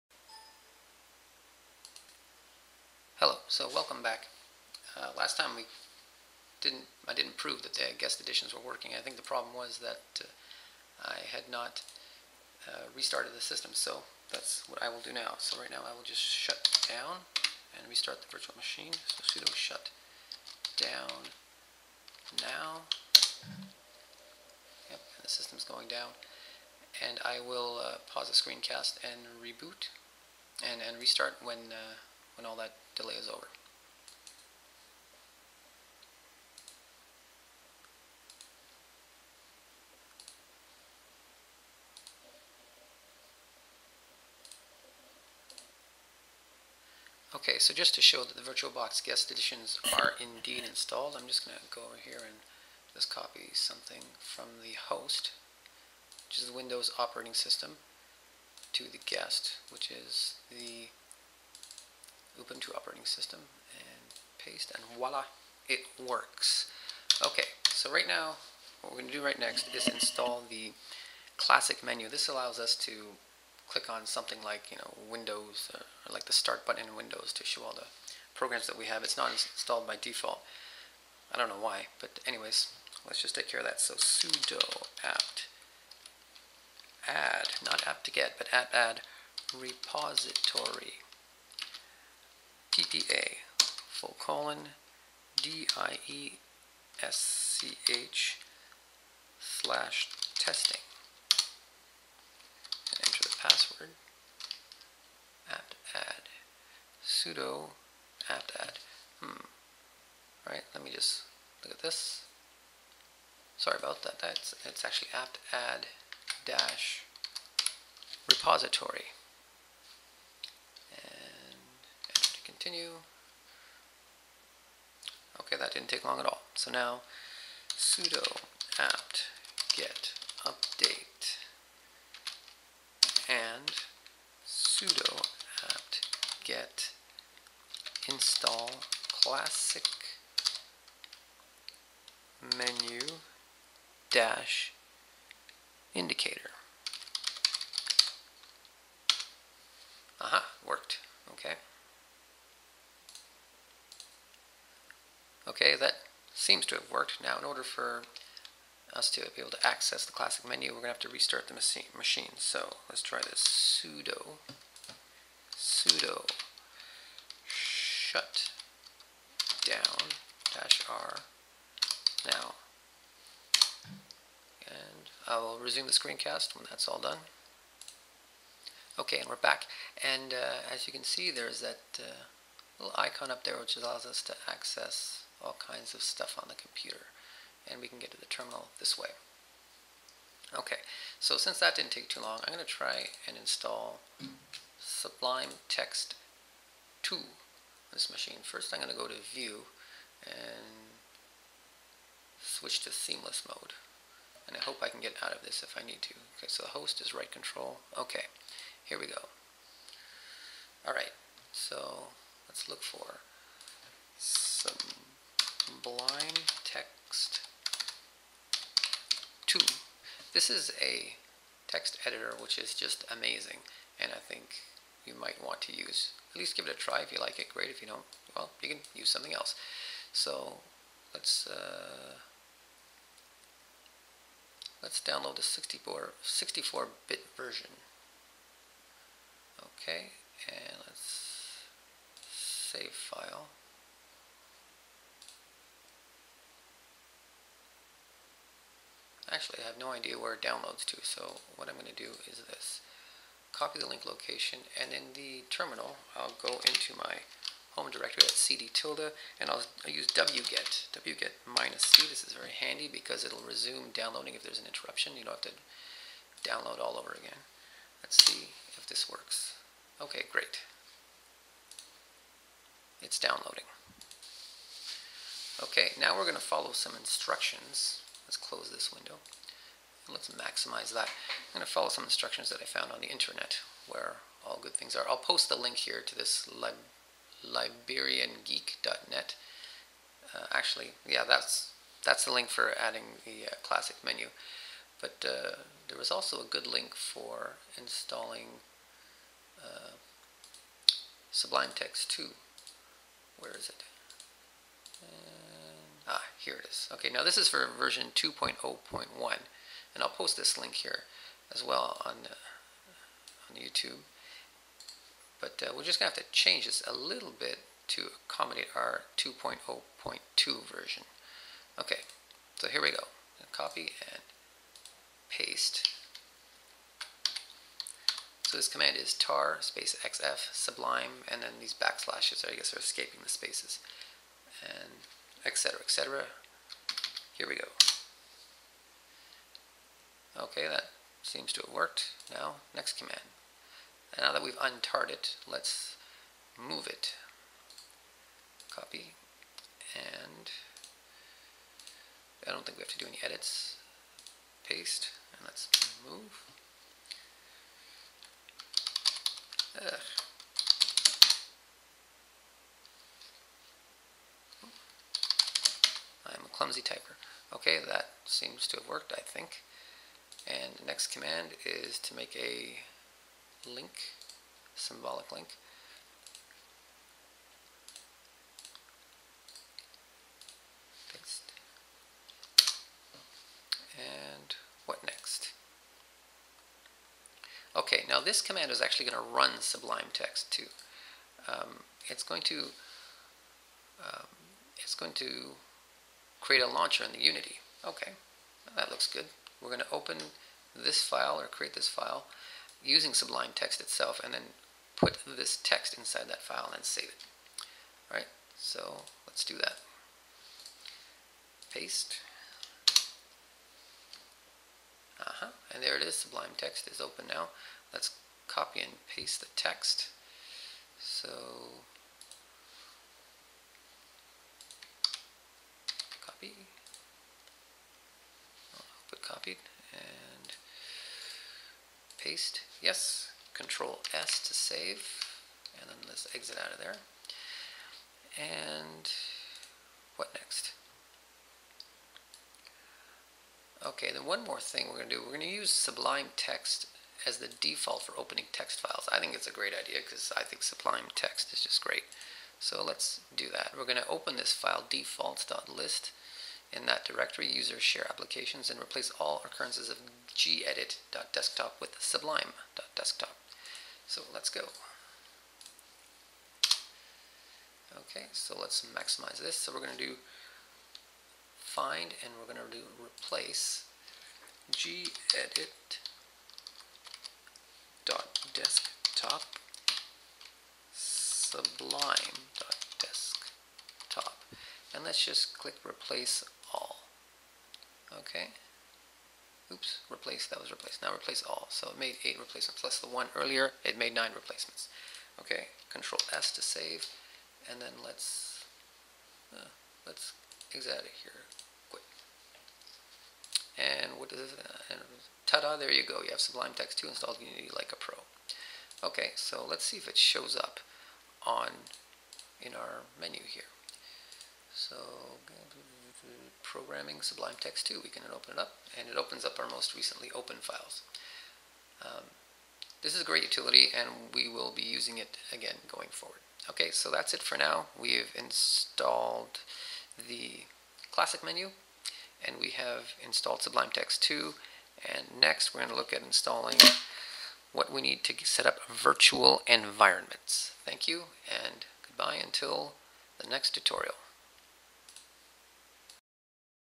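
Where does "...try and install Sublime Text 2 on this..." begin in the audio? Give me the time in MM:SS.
03:12.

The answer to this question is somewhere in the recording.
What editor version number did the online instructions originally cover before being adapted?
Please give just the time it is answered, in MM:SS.
05:08.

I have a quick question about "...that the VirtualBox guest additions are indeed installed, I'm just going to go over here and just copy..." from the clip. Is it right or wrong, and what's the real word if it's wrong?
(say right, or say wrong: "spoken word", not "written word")
right.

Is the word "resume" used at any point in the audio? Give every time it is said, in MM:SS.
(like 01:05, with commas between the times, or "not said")
02:55, 04:23.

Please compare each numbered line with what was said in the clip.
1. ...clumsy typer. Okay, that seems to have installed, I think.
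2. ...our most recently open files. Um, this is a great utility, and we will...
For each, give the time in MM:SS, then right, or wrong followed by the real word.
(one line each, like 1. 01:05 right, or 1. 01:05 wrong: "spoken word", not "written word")
1. 06:06 wrong: "worked", not "installed"
2. 08:39 right.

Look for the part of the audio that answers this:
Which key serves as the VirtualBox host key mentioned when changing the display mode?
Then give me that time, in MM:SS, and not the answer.
03:27.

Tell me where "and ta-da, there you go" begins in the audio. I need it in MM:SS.
08:24.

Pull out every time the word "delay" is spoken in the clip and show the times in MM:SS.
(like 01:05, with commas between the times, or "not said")
00:33.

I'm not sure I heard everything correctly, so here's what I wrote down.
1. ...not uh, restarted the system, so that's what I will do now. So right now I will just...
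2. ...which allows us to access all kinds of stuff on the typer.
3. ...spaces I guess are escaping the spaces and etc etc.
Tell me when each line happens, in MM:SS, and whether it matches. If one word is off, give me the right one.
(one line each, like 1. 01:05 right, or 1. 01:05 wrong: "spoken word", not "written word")
1. 00:11 right
2. 03:03 wrong: "computer", not "typer"
3. 05:31 wrong: "backslashes", not "spaces".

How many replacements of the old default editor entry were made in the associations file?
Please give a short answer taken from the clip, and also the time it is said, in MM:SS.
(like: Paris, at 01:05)
9, at 08:14.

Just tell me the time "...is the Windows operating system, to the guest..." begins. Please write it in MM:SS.
00:56.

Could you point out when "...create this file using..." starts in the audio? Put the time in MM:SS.
06:41.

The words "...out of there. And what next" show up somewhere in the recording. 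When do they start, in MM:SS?
07:16.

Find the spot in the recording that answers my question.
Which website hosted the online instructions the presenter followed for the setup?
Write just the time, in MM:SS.
04:47.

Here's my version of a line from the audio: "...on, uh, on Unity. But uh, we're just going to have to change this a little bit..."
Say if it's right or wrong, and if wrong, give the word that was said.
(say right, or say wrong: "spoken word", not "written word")
wrong: "YouTube", not "Unity".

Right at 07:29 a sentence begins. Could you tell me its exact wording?
I think it's a great idea because I think Sublime Text is just great.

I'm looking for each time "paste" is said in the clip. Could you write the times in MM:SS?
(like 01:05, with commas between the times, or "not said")
01:04, 05:25, 05:54, 06:51, 06:59, 07:12.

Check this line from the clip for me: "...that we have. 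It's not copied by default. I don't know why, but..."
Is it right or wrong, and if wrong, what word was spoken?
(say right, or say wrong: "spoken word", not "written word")
wrong: "installed", not "copied".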